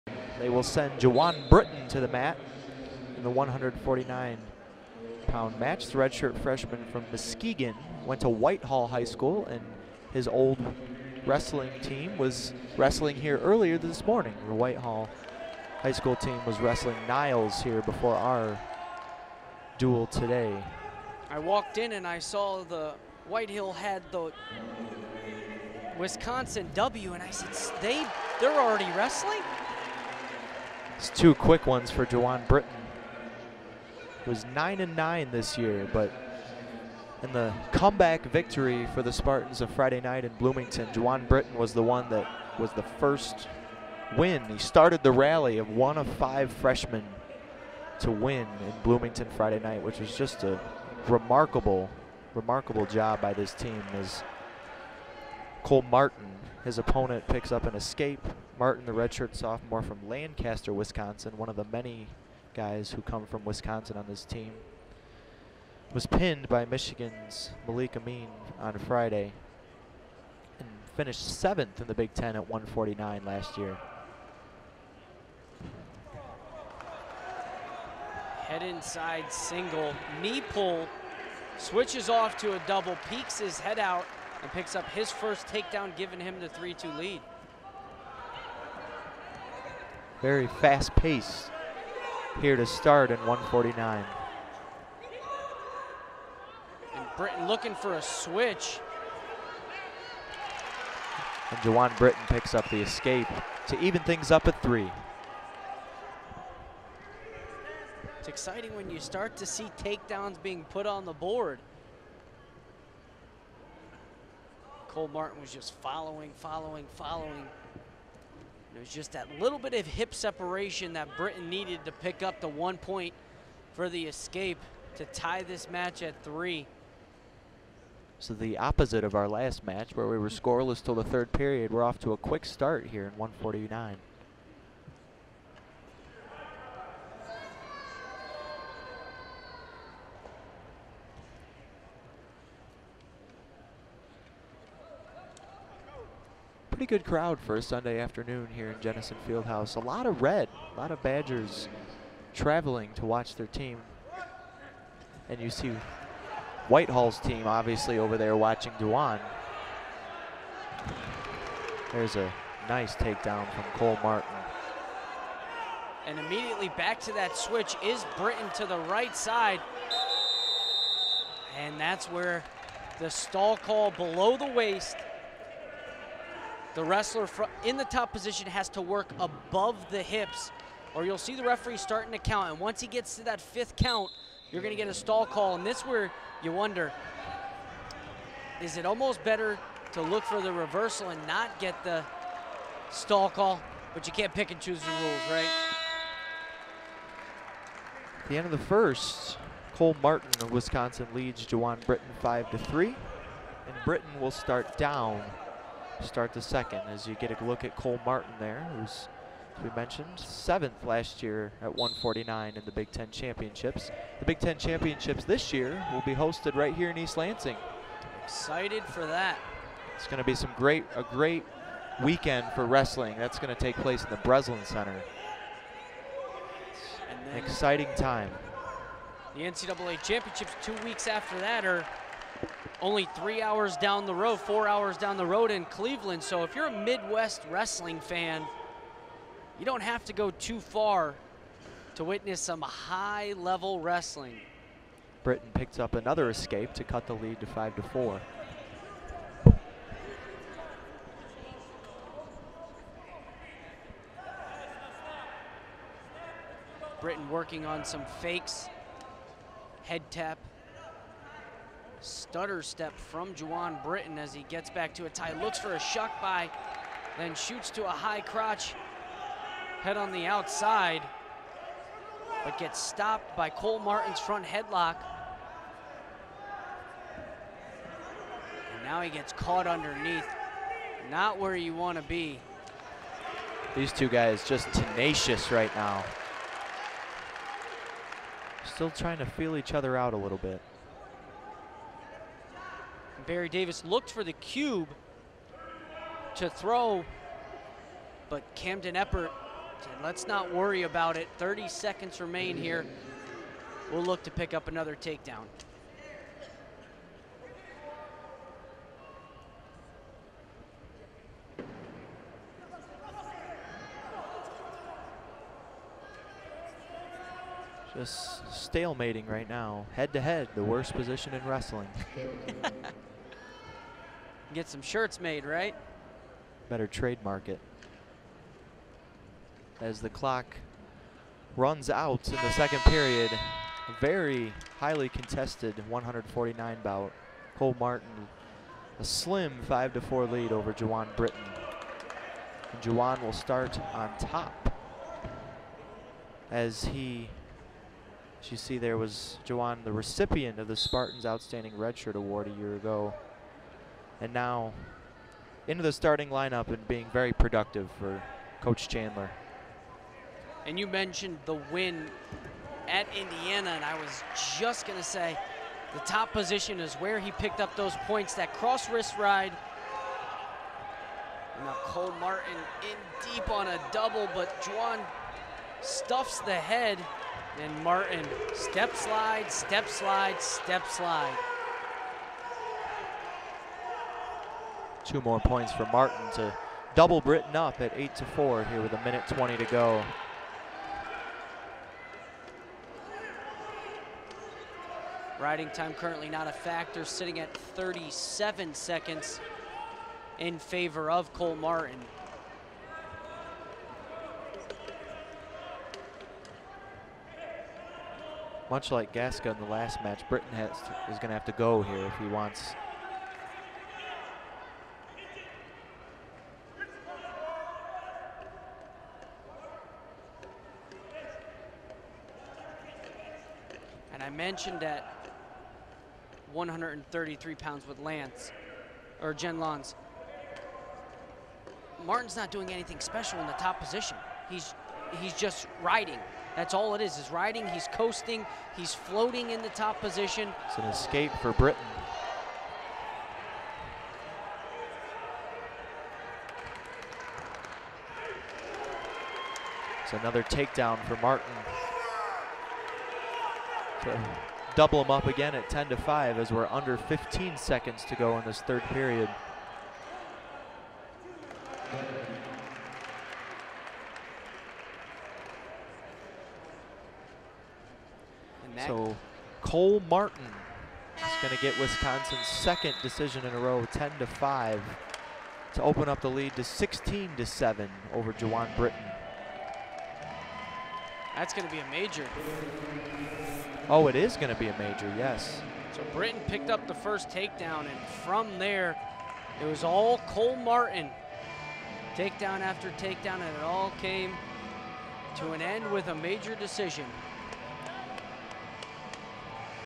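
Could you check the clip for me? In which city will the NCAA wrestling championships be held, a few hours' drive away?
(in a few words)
Cleveland.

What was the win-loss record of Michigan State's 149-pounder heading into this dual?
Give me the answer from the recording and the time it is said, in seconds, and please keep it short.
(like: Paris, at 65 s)
9 and 9, at 34 s.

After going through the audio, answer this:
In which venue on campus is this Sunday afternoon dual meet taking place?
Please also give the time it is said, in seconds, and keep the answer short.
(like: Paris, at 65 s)
Jennison Fieldhouse, at 148 s.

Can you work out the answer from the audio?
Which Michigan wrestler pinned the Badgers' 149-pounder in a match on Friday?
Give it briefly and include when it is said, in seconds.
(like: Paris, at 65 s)
Malik Amin, at 67 s.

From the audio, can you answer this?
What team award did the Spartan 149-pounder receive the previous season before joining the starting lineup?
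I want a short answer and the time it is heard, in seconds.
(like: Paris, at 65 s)
Outstanding Redshirt Award, at 351 s.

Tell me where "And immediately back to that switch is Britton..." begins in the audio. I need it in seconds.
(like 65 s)
166 s.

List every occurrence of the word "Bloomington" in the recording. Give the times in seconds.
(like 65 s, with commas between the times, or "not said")
40 s, 48 s.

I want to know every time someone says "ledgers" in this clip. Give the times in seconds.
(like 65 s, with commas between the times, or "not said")
not said.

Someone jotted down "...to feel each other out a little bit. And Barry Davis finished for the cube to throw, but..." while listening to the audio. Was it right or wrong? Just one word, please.
wrong.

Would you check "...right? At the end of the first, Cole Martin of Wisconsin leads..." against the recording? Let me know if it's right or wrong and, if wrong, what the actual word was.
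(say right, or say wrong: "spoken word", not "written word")
right.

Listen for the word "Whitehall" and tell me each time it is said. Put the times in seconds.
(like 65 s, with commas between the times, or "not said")
8 s, 14 s, 23 s, 156 s.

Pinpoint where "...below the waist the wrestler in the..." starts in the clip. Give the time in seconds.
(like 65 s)
173 s.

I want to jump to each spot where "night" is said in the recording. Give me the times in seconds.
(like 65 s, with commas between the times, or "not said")
39 s, 49 s.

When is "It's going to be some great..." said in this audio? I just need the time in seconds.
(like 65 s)
219 s.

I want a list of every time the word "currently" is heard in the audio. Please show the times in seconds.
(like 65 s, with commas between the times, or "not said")
395 s.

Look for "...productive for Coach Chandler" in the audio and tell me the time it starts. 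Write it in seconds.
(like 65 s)
357 s.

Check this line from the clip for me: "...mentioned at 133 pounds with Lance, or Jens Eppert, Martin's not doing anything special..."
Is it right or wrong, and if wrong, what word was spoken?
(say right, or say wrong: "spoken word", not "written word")
wrong: "Lantz", not "Eppert".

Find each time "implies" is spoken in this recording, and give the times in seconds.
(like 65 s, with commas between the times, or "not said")
not said.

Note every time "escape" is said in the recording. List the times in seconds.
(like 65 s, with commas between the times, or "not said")
57 s, 102 s, 124 s, 246 s, 440 s.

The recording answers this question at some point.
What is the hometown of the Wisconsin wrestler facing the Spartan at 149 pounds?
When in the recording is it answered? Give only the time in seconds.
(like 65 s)
60 s.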